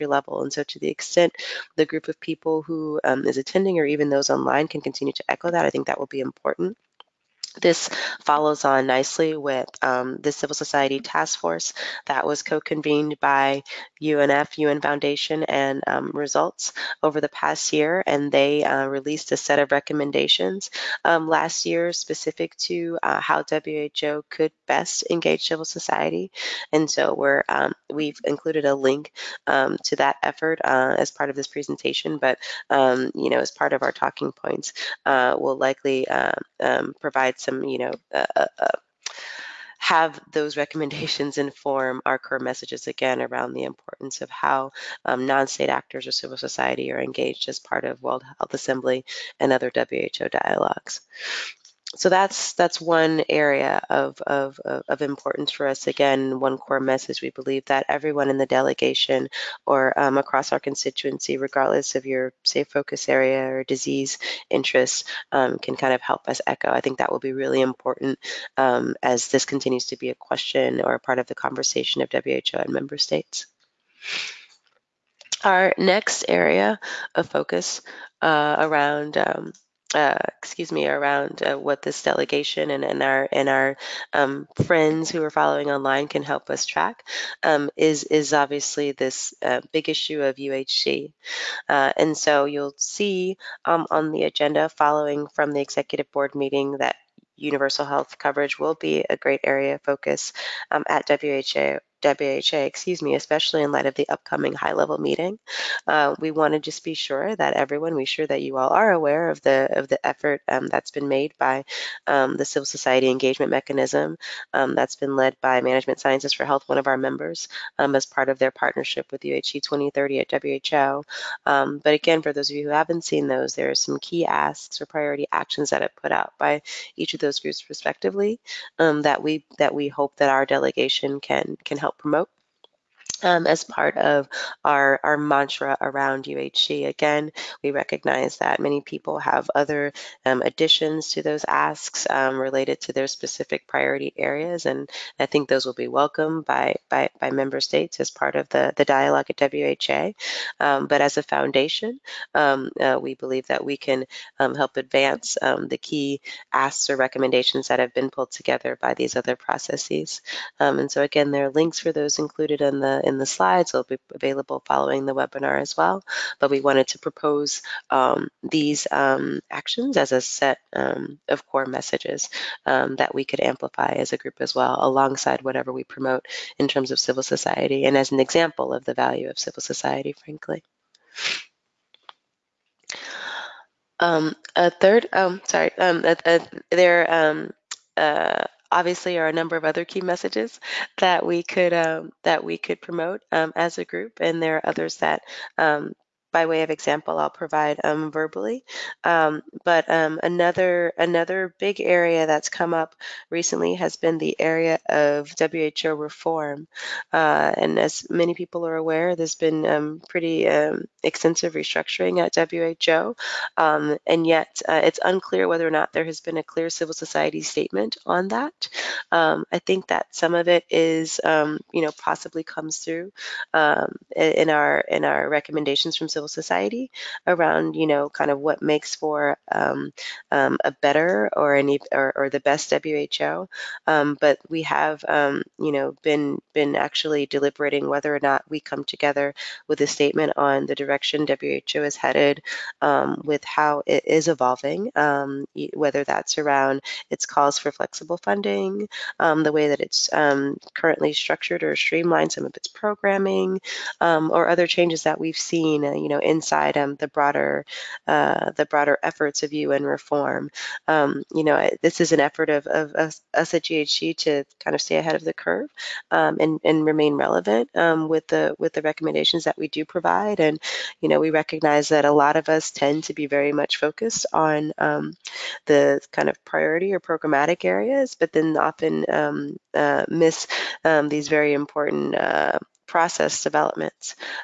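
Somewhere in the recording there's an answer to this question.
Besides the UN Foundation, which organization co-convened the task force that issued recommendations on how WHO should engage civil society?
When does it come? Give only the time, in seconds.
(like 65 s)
16 s.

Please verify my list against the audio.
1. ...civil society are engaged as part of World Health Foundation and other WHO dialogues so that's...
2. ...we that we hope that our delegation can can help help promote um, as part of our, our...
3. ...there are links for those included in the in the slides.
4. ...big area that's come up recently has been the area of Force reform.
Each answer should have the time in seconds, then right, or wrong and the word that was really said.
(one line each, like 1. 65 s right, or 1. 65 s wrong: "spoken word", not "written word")
1. 46 s wrong: "Assembly", not "Foundation"
2. 129 s right
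3. 161 s right
4. 201 s wrong: "WHO", not "Force".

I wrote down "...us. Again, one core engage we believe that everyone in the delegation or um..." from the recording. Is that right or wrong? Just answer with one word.
wrong.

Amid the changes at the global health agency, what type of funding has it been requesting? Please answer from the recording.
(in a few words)
flexible funding.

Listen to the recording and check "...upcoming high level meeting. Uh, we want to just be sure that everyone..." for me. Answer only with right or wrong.
right.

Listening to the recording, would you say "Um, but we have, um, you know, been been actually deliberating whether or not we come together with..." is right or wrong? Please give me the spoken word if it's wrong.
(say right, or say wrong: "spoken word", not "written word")
right.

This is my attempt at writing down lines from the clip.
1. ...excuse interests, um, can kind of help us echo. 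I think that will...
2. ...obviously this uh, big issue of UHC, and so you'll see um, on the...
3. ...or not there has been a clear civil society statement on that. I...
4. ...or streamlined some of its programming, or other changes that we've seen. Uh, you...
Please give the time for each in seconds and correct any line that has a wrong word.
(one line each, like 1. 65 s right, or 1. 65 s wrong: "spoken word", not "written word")
1. 63 s wrong: "disease", not "excuse"
2. 88 s right
3. 215 s right
4. 251 s right.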